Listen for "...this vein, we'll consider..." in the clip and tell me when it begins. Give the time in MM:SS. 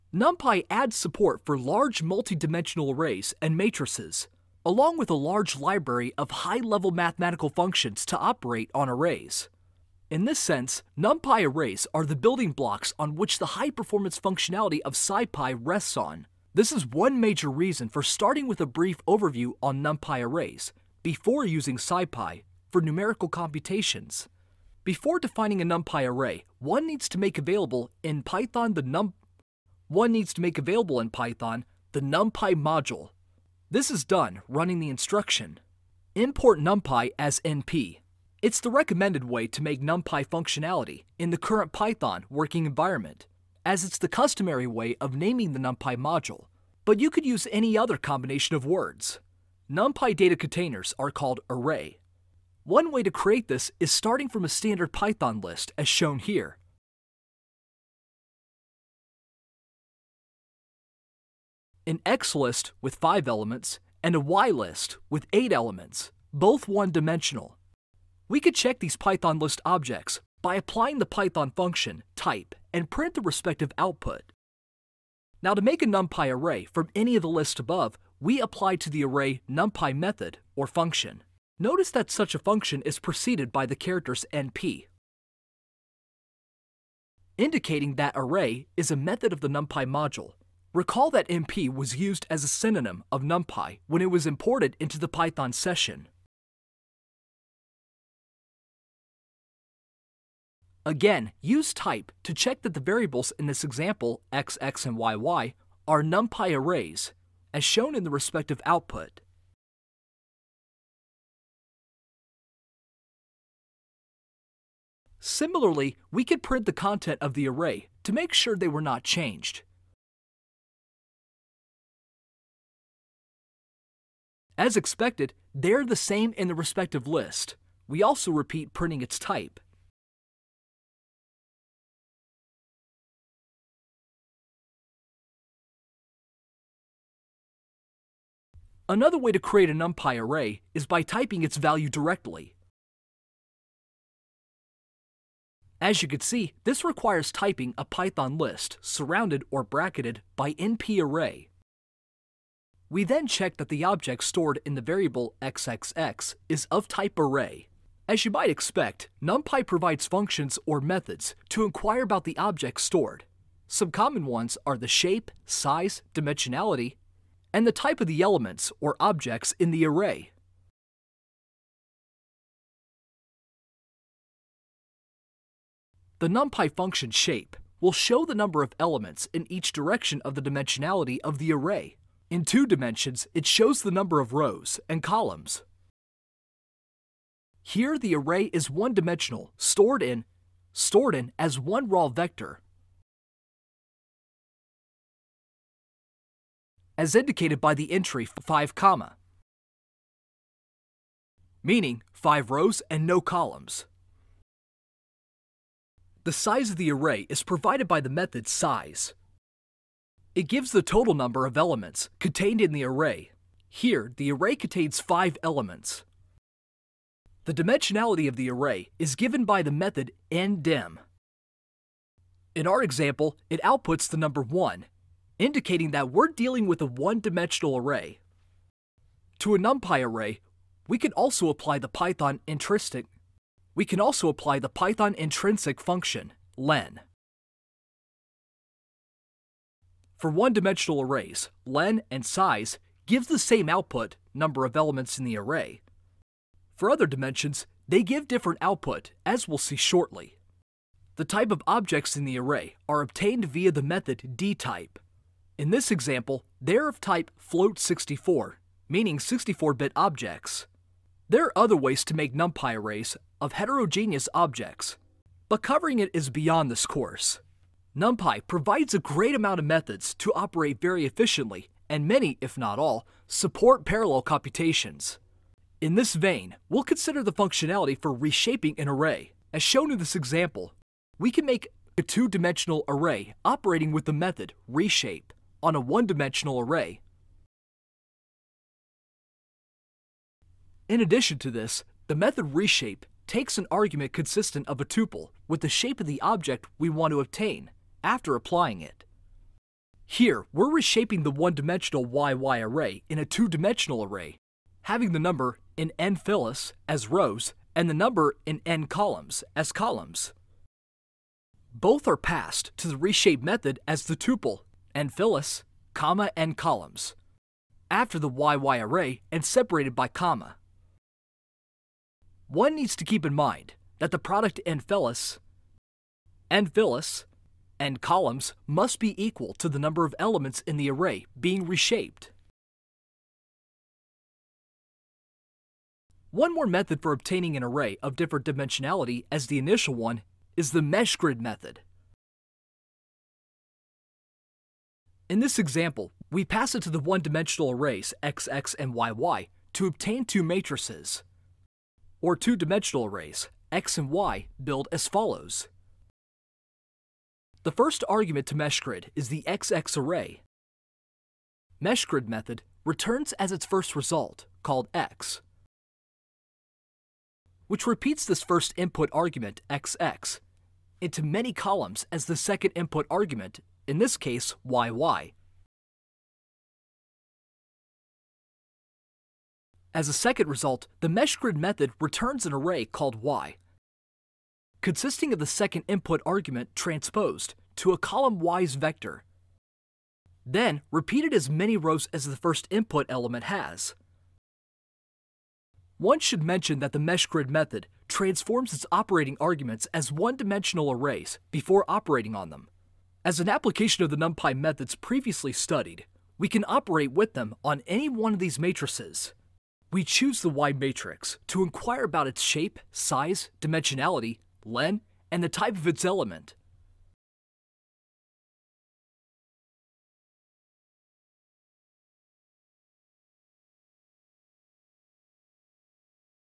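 04:35.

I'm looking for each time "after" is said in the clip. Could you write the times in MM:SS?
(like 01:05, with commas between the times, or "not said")
04:58, 05:17.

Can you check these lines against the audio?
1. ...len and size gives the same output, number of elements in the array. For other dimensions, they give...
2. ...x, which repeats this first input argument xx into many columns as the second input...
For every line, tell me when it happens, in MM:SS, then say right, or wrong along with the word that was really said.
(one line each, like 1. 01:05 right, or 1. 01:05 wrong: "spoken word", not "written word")
1. 04:01 right
2. 06:04 right.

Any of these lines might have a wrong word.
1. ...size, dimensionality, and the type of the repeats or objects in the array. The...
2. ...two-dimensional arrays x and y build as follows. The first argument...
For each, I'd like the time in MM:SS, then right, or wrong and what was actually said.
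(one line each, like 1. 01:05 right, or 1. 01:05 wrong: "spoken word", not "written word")
1. 02:45 wrong: "elements", not "repeats"
2. 05:52 right.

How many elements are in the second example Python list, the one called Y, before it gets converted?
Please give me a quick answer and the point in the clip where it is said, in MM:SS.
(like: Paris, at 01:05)
8, at 01:05.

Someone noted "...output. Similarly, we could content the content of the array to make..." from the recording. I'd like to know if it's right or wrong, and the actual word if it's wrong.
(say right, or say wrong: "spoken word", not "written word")
wrong: "print", not "content".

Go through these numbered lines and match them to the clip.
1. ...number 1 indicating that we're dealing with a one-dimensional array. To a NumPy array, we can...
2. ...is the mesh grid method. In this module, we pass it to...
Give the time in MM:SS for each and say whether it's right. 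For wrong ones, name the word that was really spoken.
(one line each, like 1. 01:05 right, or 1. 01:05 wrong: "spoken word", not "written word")
1. 03:44 right
2. 05:40 wrong: "example", not "module".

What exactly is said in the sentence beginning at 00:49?
NumPy data containers are called array.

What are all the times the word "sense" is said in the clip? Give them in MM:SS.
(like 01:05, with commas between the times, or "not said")
00:10.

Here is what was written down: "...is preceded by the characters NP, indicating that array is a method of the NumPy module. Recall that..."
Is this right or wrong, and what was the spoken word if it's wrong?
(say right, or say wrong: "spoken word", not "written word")
right.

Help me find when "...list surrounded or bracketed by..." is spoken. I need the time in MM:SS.
02:28.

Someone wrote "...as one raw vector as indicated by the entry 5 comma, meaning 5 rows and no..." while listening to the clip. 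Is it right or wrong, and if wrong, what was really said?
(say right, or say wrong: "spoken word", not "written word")
right.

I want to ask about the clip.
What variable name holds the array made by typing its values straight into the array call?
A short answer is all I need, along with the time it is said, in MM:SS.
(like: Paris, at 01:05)
xxx, at 02:35.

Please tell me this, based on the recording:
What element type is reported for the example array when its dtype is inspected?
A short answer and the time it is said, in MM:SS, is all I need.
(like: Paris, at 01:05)
float64, at 04:17.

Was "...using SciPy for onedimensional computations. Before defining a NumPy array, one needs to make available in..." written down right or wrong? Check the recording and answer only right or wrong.
wrong.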